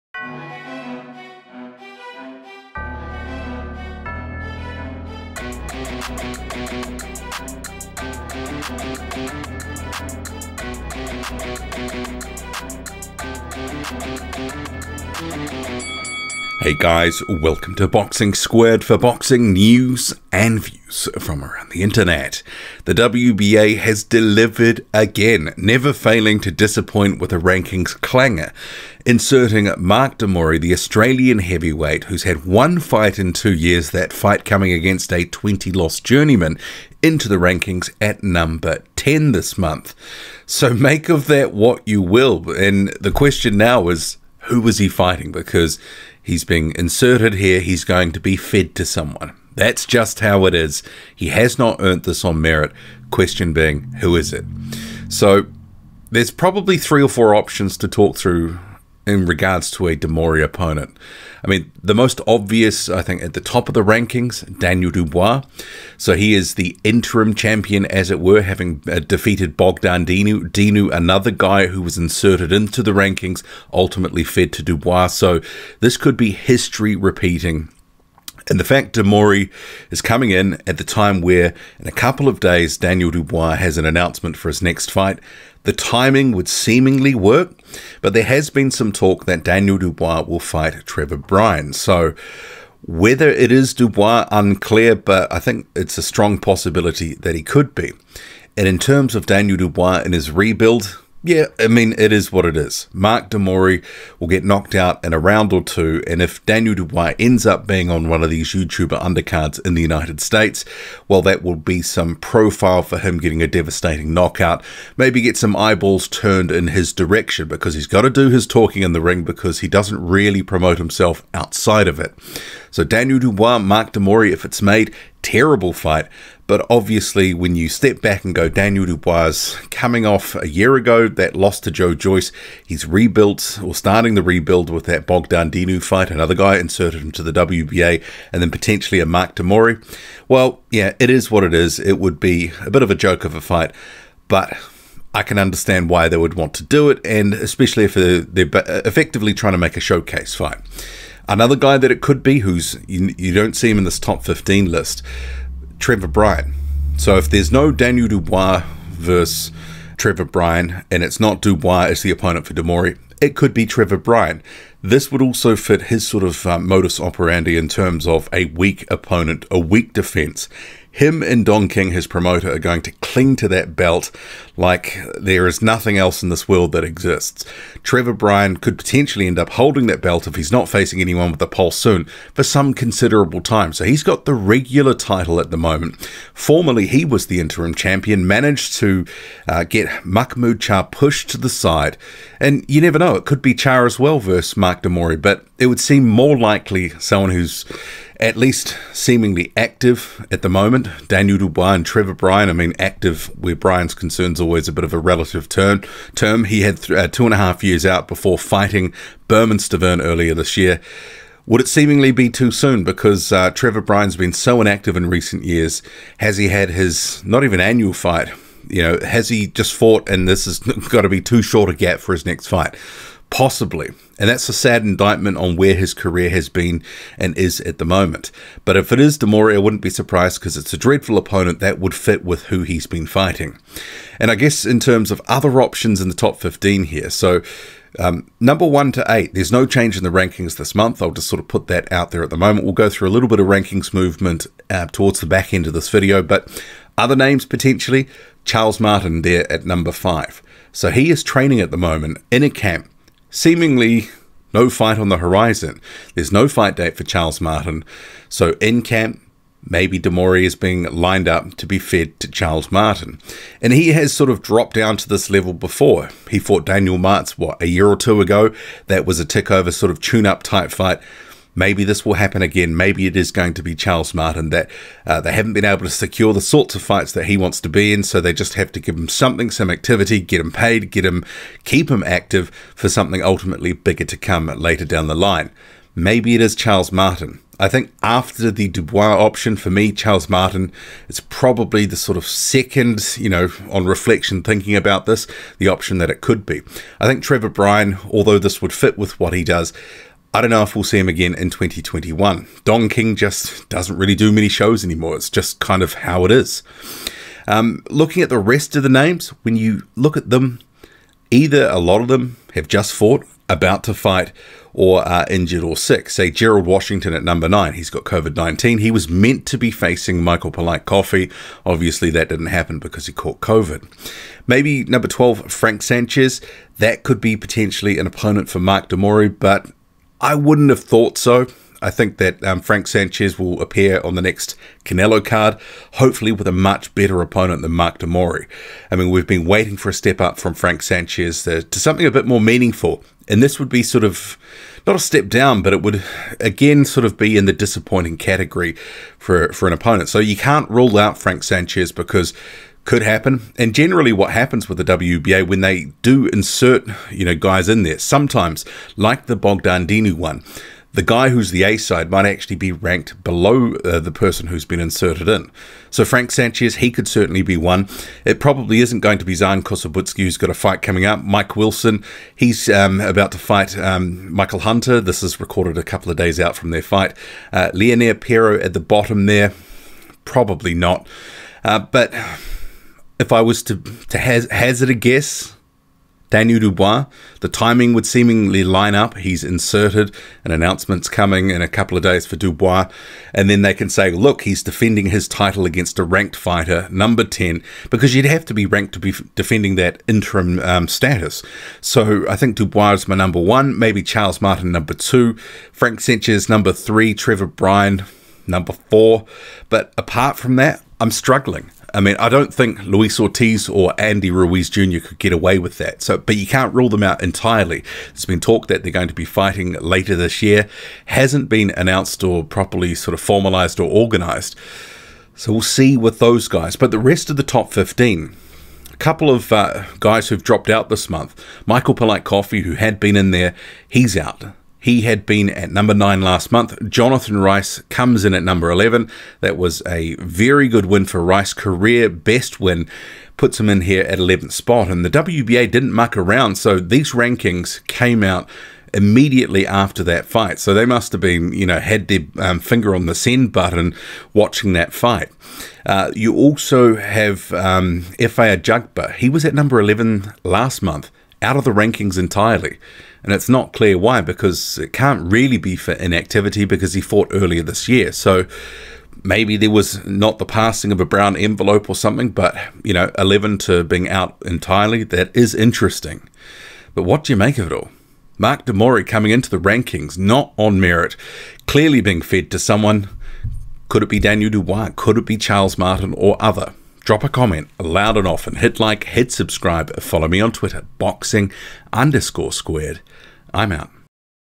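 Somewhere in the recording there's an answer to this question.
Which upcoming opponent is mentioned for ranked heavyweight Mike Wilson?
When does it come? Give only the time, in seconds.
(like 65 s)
374 s.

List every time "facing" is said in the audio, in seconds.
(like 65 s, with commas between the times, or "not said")
180 s, 319 s.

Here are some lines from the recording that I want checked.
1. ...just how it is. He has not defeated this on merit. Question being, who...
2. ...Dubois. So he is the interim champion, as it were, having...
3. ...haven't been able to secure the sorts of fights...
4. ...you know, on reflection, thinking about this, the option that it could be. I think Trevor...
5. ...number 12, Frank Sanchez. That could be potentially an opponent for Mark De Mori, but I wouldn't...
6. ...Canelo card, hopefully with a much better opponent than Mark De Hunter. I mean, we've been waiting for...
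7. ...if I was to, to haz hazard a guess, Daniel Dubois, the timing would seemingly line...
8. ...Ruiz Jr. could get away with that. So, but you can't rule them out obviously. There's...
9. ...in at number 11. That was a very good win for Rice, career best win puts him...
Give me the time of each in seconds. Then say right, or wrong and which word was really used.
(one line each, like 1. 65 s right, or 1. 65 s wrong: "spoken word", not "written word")
1. 49 s wrong: "earned", not "defeated"
2. 64 s right
3. 275 s right
4. 293 s right
5. 324 s right
6. 334 s wrong: "Mori", not "Hunter"
7. 383 s right
8. 414 s wrong: "entirely", not "obviously"
9. 438 s right.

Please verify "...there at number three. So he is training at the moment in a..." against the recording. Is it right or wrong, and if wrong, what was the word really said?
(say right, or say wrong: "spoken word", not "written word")
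wrong: "five", not "three".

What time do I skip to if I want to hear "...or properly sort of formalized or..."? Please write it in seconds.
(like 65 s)
422 s.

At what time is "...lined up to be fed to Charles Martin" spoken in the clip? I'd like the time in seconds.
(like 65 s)
260 s.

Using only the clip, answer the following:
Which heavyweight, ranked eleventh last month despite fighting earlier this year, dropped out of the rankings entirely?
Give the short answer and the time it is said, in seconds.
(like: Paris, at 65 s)
Efe Ajagba, at 458 s.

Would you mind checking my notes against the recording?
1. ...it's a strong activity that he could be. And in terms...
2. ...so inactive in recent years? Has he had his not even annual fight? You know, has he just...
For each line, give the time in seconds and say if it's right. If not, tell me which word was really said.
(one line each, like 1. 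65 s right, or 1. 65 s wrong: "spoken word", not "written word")
1. 95 s wrong: "possibility", not "activity"
2. 214 s right.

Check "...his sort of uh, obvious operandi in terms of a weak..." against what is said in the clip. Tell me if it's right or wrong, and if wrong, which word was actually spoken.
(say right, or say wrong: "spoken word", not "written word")
wrong: "modus", not "obvious".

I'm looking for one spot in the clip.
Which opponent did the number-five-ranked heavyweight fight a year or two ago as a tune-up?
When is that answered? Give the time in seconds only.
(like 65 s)
266 s.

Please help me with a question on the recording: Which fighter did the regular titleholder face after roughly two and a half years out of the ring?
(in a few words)
Bermane Stiverne.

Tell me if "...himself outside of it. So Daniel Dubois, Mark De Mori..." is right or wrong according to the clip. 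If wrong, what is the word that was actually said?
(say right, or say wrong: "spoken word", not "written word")
right.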